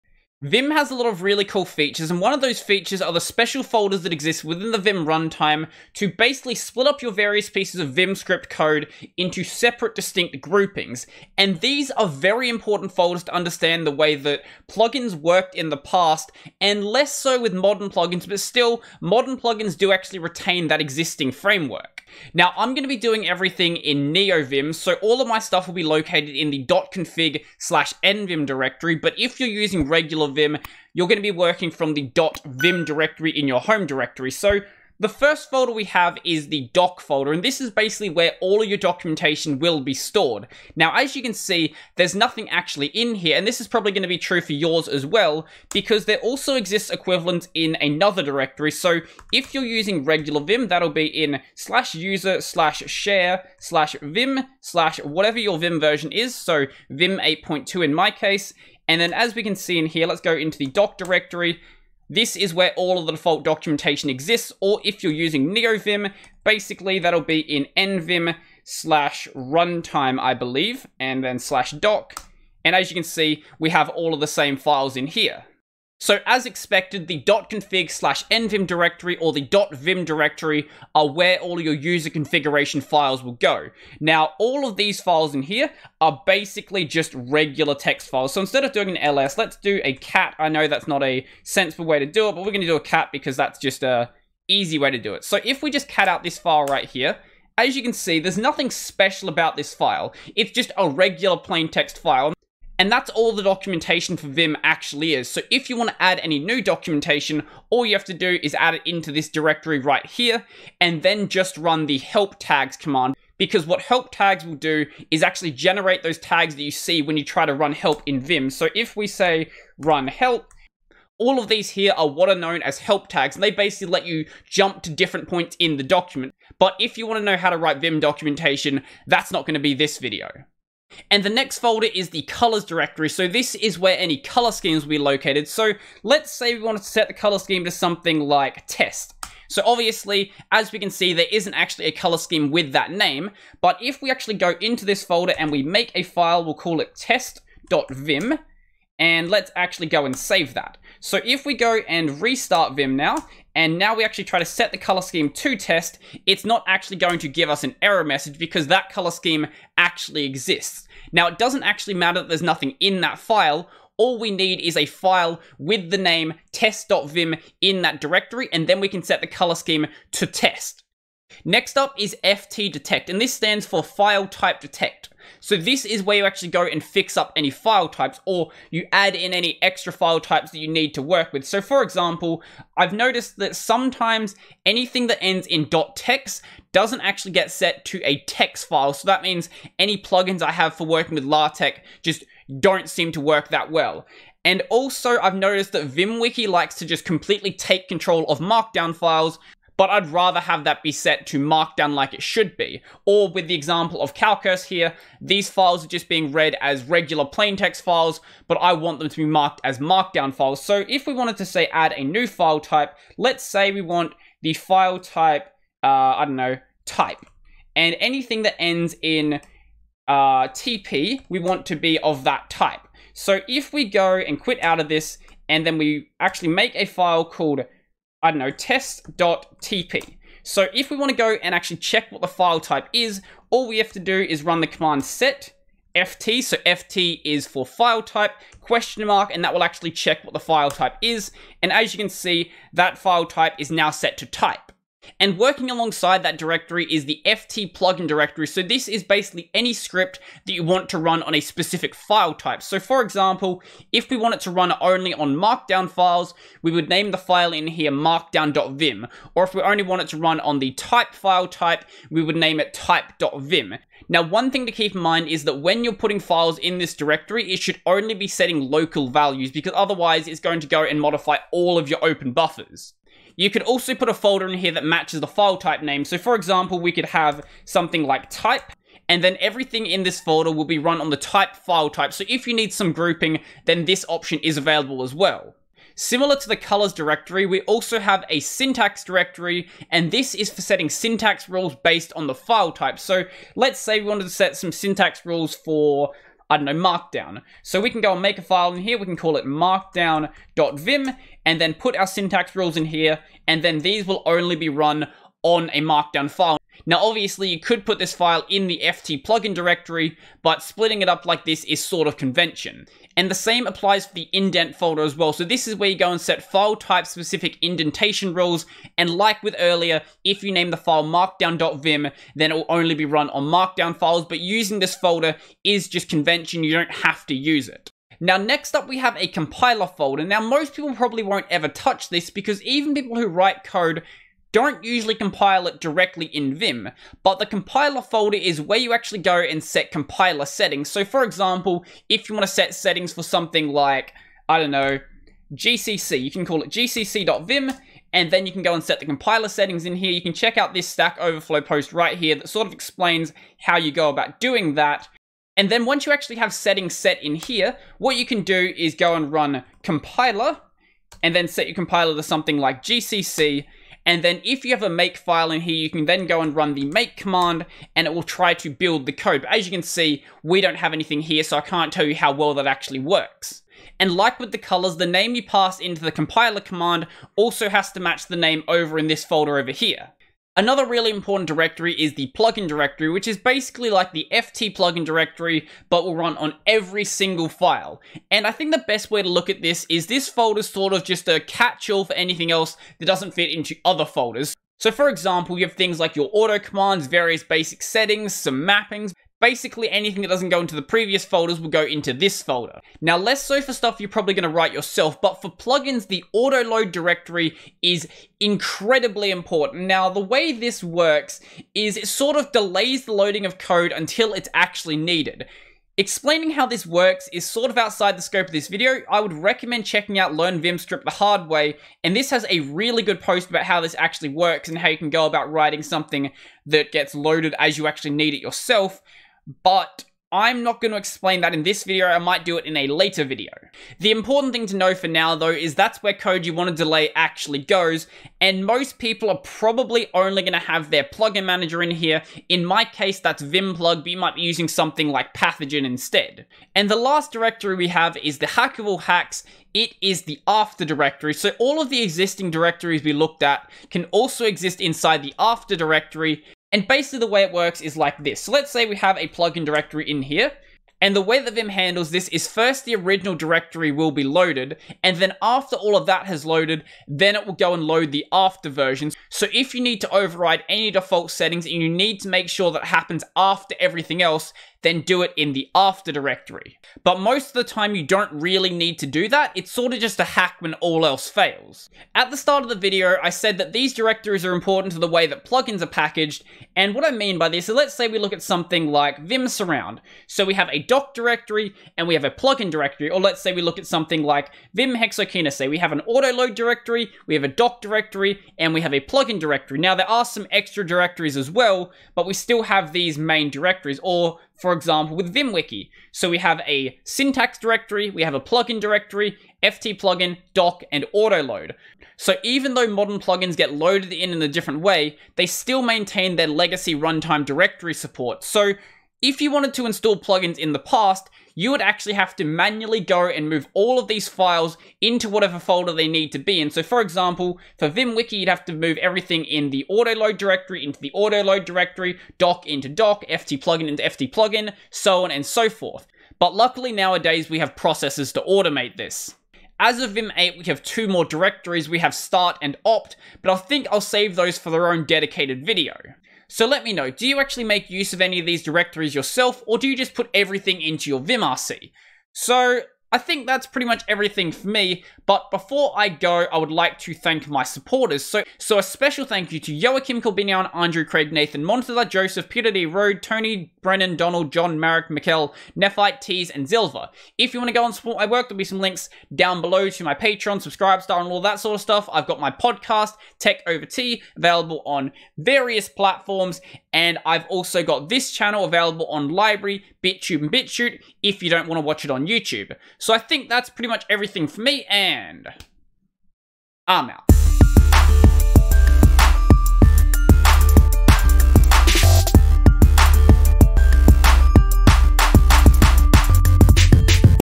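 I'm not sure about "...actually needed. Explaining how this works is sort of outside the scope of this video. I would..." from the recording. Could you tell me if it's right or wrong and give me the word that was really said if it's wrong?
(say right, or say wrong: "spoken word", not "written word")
right.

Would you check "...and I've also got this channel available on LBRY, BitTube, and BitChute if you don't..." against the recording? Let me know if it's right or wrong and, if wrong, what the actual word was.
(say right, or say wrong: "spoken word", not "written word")
right.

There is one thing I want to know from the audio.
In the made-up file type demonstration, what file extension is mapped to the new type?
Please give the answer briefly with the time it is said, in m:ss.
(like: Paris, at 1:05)
TP, at 3:40.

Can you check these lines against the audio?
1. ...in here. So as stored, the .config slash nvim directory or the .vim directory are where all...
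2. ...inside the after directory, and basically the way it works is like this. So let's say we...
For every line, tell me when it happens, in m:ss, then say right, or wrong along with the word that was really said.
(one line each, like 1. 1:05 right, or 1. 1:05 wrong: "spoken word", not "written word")
1. 1:14 wrong: "expected", not "stored"
2. 7:34 right.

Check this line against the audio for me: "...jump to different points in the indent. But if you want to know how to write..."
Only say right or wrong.
wrong.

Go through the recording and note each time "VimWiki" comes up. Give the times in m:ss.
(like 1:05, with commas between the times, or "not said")
3:15, 8:25, 8:47.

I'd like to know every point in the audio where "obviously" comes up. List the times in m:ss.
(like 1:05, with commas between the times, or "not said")
2:19, 5:07.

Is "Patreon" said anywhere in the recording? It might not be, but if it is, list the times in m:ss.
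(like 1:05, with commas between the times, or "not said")
9:30.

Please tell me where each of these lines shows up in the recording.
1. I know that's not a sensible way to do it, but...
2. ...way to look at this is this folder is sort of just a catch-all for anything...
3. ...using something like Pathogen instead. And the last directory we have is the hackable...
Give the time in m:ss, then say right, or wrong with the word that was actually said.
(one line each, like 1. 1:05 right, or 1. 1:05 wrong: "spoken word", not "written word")
1. 1:30 right
2. 6:29 right
3. 7:24 right.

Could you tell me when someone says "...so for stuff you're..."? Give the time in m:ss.
6:43.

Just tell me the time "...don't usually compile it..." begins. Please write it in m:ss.
5:34.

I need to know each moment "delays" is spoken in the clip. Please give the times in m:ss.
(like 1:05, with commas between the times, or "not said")
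6:52, 7:16.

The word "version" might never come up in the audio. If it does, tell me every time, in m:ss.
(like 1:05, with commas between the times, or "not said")
0:55, 7:48.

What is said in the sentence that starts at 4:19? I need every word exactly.
Or if we only want it to run on the type file type, we would name it type.vim.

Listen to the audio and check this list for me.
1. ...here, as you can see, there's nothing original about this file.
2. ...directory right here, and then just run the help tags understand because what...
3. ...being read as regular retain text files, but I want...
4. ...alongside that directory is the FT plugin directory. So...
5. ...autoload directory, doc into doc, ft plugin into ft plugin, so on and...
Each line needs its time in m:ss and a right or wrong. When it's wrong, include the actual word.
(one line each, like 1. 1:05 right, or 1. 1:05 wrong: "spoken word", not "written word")
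1. 1:36 wrong: "special", not "original"
2. 1:49 wrong: "command", not "understand"
3. 3:26 wrong: "plain", not "retain"
4. 4:05 right
5. 8:51 right.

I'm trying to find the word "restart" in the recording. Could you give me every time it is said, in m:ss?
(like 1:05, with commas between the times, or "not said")
2:32.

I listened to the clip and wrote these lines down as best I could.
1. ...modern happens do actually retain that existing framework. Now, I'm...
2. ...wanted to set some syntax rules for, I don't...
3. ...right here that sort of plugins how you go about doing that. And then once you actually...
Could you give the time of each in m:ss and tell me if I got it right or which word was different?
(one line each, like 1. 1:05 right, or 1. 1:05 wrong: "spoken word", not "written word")
1. 0:18 wrong: "plugins", not "happens"
2. 4:54 right
3. 5:51 wrong: "explains", not "plugins".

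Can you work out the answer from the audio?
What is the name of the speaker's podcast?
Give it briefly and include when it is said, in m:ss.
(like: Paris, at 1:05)
Tech Over Tea, at 9:33.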